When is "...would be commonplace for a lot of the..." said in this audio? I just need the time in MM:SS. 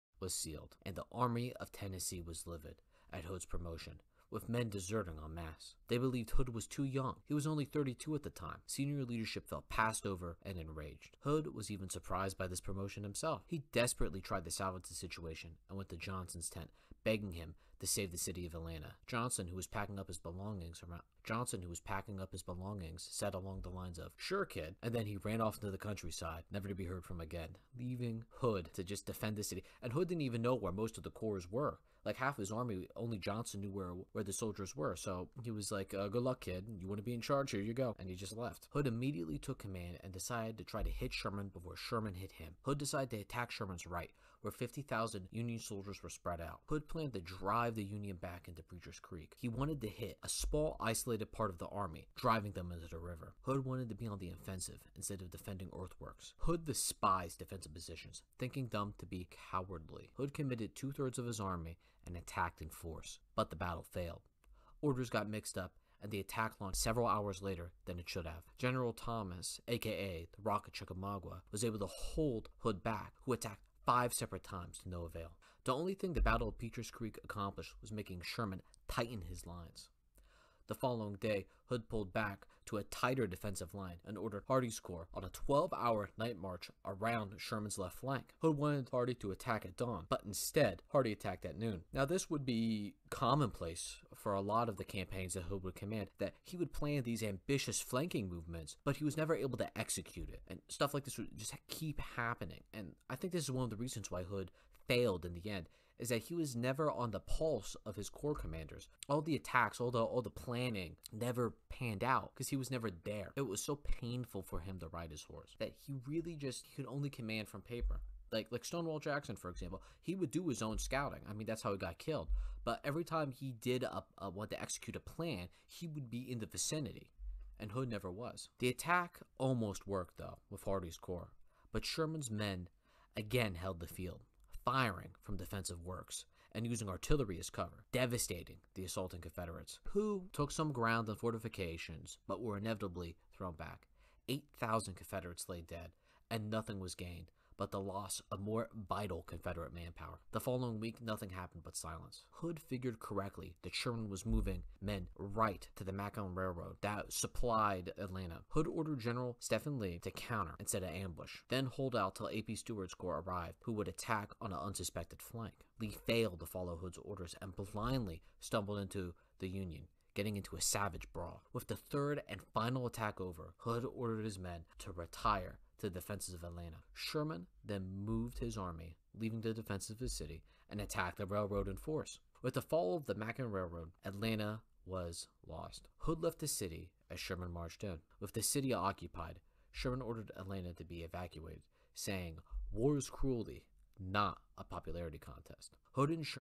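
01:32.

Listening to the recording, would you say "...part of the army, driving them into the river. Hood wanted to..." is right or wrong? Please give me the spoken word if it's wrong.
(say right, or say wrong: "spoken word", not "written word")
right.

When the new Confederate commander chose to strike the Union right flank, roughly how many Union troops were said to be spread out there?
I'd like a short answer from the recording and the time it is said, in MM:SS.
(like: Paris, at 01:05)
50,000, at 00:44.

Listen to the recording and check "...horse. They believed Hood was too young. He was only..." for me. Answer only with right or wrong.
wrong.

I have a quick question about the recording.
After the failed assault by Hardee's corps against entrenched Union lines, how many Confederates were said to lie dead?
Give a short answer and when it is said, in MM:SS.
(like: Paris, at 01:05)
8,000, at 02:24.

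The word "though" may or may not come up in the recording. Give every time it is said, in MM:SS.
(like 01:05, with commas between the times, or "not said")
02:10.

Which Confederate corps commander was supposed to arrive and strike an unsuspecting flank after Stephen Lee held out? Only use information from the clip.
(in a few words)
A.P. Stewart.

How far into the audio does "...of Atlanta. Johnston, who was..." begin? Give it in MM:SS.
00:18.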